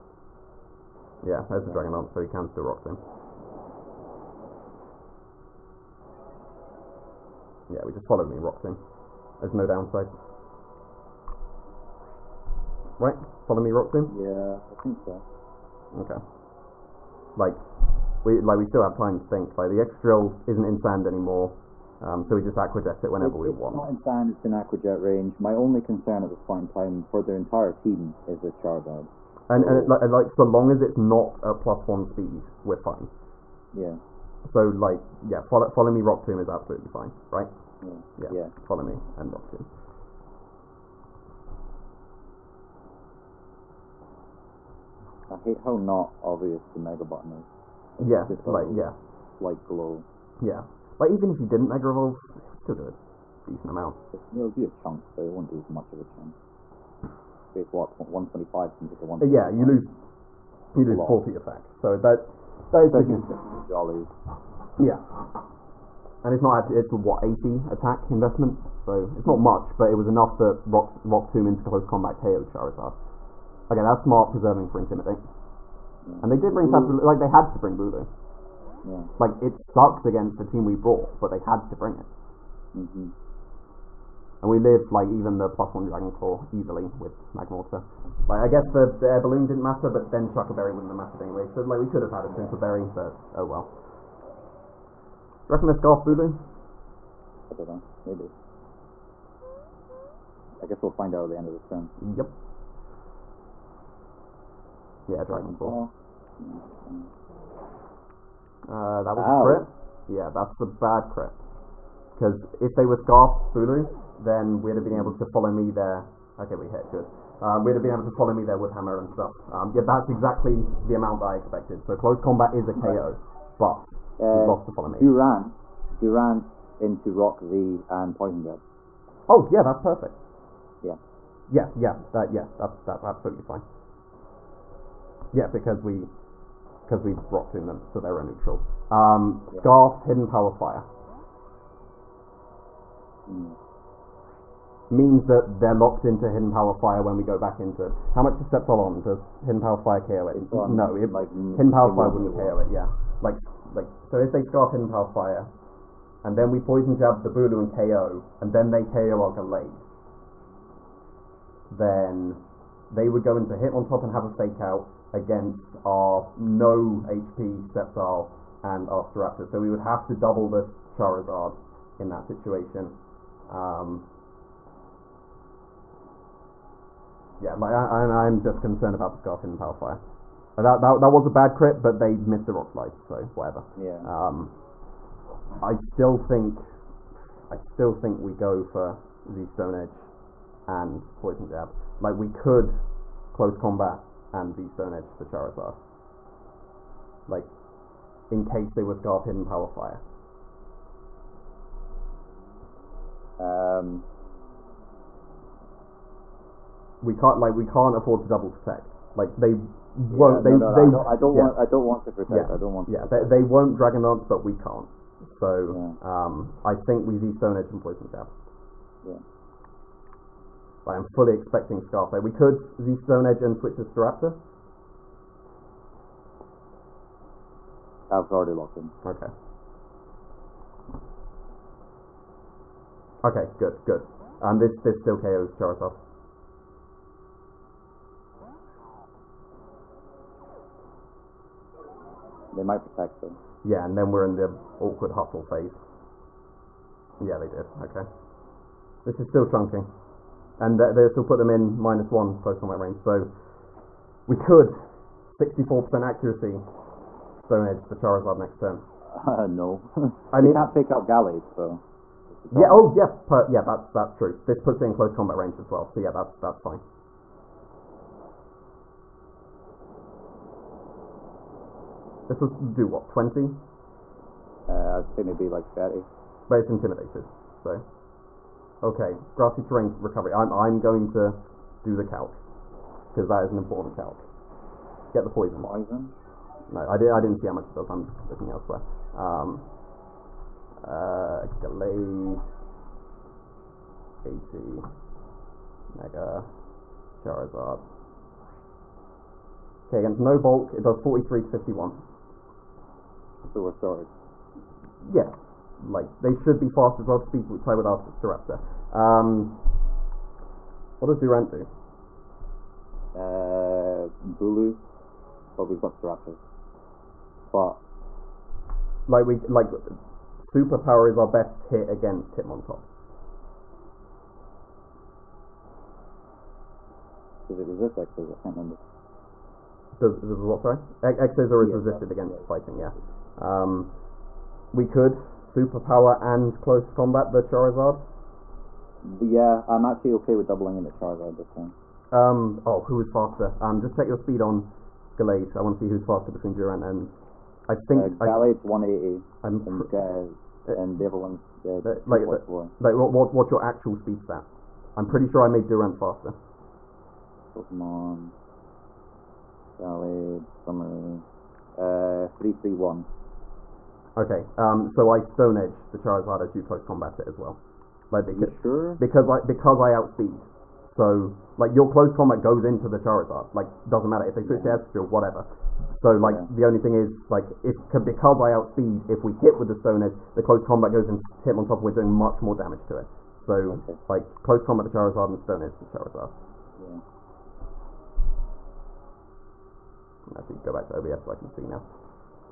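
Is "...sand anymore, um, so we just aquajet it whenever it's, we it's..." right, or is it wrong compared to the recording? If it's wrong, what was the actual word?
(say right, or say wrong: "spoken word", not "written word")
right.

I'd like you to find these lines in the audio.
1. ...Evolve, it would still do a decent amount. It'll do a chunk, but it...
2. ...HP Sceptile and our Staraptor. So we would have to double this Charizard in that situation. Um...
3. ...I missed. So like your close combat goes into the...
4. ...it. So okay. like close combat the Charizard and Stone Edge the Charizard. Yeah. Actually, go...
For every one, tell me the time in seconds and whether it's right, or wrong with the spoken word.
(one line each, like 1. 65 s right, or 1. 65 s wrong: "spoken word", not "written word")
1. 51 s right
2. 166 s right
3. 369 s wrong: "outspeed", not "missed"
4. 382 s right.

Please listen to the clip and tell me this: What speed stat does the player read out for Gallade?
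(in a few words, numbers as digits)
331.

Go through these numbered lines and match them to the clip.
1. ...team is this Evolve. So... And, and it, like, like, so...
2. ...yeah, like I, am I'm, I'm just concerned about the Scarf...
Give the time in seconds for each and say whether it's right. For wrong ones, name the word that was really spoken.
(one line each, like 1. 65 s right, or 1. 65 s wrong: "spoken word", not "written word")
1. 27 s wrong: "Charizard", not "Evolve"
2. 177 s right.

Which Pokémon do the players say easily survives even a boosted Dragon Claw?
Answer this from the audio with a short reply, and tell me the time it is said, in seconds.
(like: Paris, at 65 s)
Magmortar, at 87 s.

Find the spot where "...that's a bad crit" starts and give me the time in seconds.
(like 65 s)
110 s.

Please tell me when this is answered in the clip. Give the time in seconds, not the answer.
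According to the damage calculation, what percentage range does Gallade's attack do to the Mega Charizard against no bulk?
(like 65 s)
301 s.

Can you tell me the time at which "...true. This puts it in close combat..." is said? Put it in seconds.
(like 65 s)
264 s.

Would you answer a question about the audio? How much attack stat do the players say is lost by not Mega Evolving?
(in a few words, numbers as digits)
40.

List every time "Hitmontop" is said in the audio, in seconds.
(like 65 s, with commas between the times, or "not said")
163 s, 322 s, 381 s.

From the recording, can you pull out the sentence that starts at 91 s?
So, like, we could have had a Super Berry, but oh well.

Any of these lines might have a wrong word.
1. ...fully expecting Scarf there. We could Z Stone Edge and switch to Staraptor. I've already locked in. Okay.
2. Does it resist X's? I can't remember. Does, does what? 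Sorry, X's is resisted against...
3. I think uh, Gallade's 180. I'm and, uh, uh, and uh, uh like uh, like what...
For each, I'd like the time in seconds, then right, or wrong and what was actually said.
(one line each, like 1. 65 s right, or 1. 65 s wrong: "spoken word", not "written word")
1. 221 s right
2. 327 s right
3. 347 s right.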